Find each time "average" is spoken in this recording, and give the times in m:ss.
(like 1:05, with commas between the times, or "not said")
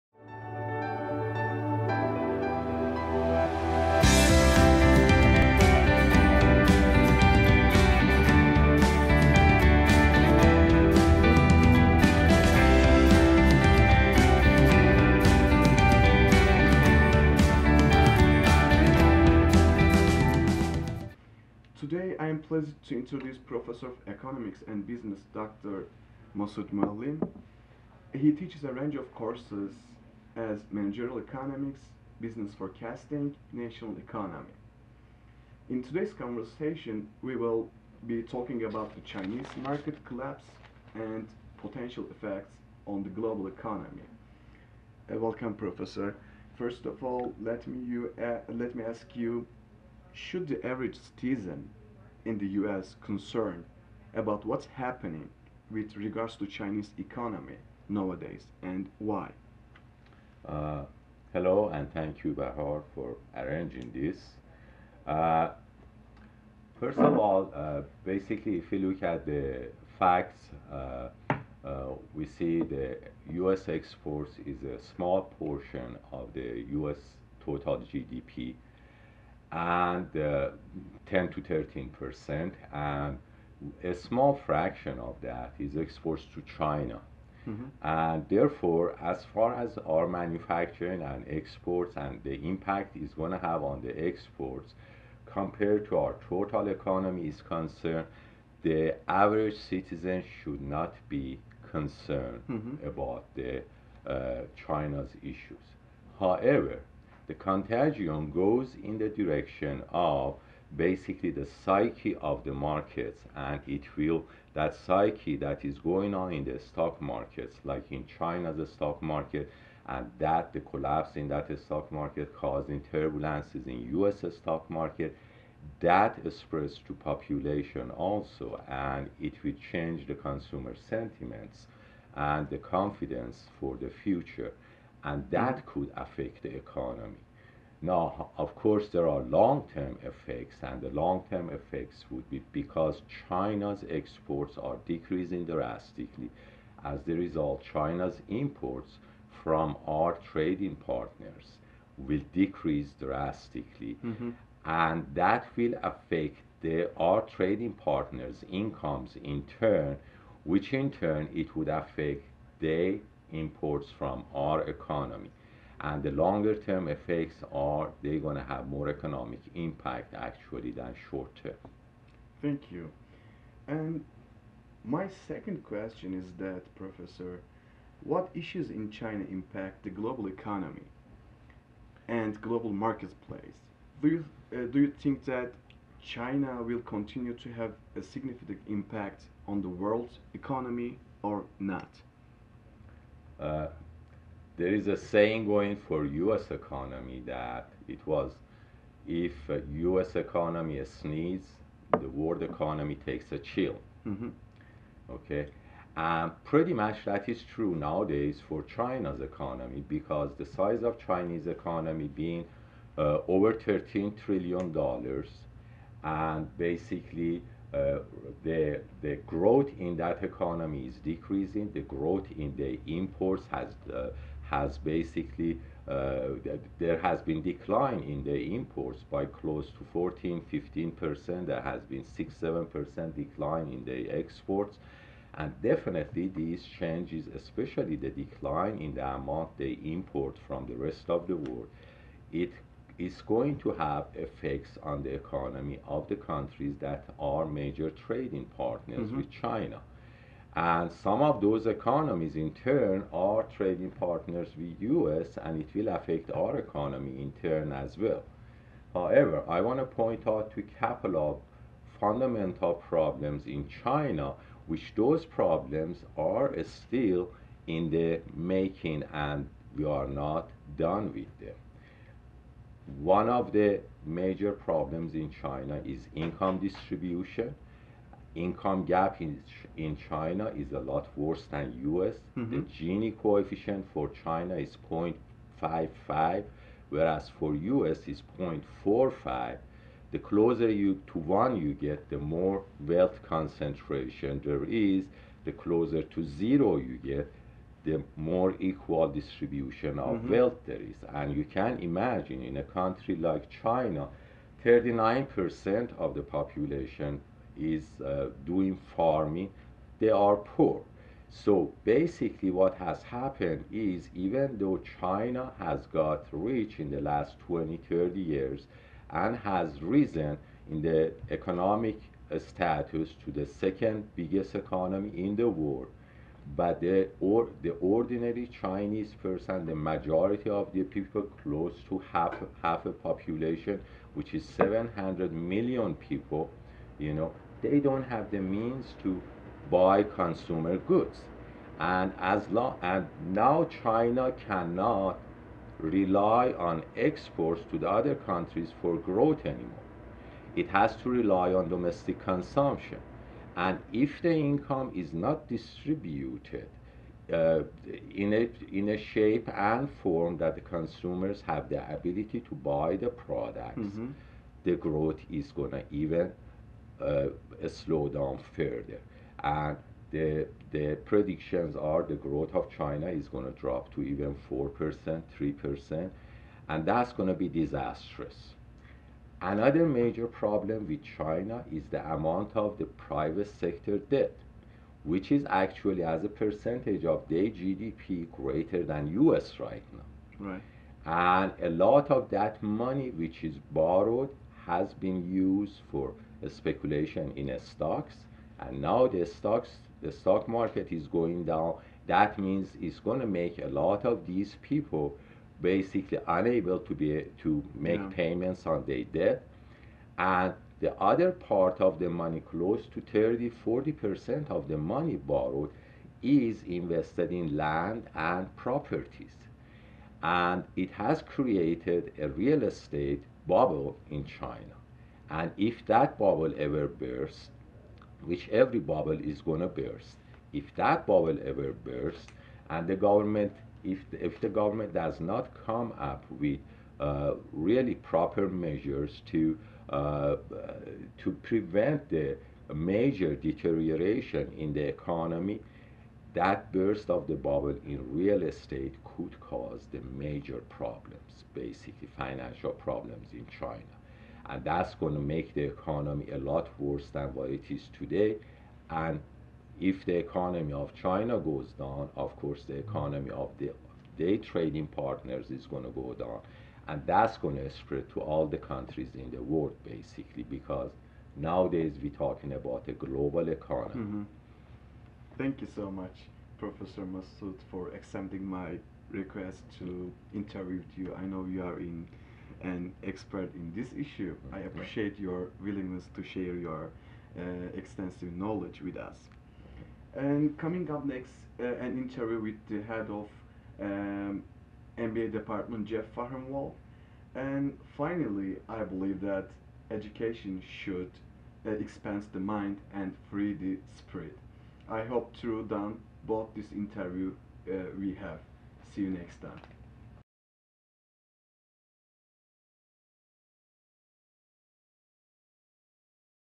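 0:50, 1:39.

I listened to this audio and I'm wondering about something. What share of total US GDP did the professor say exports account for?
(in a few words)
10 to 13 percent.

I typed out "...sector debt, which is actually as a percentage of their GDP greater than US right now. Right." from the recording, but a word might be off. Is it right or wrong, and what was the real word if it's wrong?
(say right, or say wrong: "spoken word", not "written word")
right.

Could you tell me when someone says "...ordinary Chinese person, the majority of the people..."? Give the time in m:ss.
5:27.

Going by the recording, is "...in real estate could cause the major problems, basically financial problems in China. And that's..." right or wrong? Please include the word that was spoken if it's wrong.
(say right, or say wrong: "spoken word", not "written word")
right.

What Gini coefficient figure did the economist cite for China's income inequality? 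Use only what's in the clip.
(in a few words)
0.55.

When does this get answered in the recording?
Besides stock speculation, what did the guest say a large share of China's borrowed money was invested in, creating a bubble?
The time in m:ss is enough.
6:57.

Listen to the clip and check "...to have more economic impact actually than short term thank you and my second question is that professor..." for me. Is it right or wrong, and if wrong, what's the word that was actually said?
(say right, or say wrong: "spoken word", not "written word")
right.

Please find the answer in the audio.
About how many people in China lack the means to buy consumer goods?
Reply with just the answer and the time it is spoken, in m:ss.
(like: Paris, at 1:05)
700 million, at 5:34.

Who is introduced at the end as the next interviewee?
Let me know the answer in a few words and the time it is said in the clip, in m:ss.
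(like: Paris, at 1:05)
Jeff Farhamwall, at 8:15.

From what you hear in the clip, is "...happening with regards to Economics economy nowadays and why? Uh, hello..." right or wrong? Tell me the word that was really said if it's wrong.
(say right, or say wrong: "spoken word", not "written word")
wrong: "Chinese", not "Economics".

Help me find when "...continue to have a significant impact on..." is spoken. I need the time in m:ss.
3:06.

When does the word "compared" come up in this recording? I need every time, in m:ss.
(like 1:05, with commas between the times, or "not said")
1:35.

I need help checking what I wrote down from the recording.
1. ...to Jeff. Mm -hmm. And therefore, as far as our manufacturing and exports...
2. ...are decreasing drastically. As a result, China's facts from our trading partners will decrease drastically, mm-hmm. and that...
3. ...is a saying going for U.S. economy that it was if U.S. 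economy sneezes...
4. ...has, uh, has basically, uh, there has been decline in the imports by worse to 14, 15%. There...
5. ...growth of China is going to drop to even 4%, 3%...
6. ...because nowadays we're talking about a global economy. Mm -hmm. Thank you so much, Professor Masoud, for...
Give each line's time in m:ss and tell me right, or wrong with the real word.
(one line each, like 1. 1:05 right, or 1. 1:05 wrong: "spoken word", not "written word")
1. 1:26 wrong: "China", not "Jeff"
2. 2:24 wrong: "imports", not "facts"
3. 3:14 right
4. 3:43 wrong: "close", not "worse"
5. 6:12 right
6. 7:50 right.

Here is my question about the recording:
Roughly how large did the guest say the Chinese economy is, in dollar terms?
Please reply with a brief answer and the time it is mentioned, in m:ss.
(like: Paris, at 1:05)
over 13 trillion dollars, at 3:33.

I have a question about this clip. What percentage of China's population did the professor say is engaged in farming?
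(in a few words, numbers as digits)
39%.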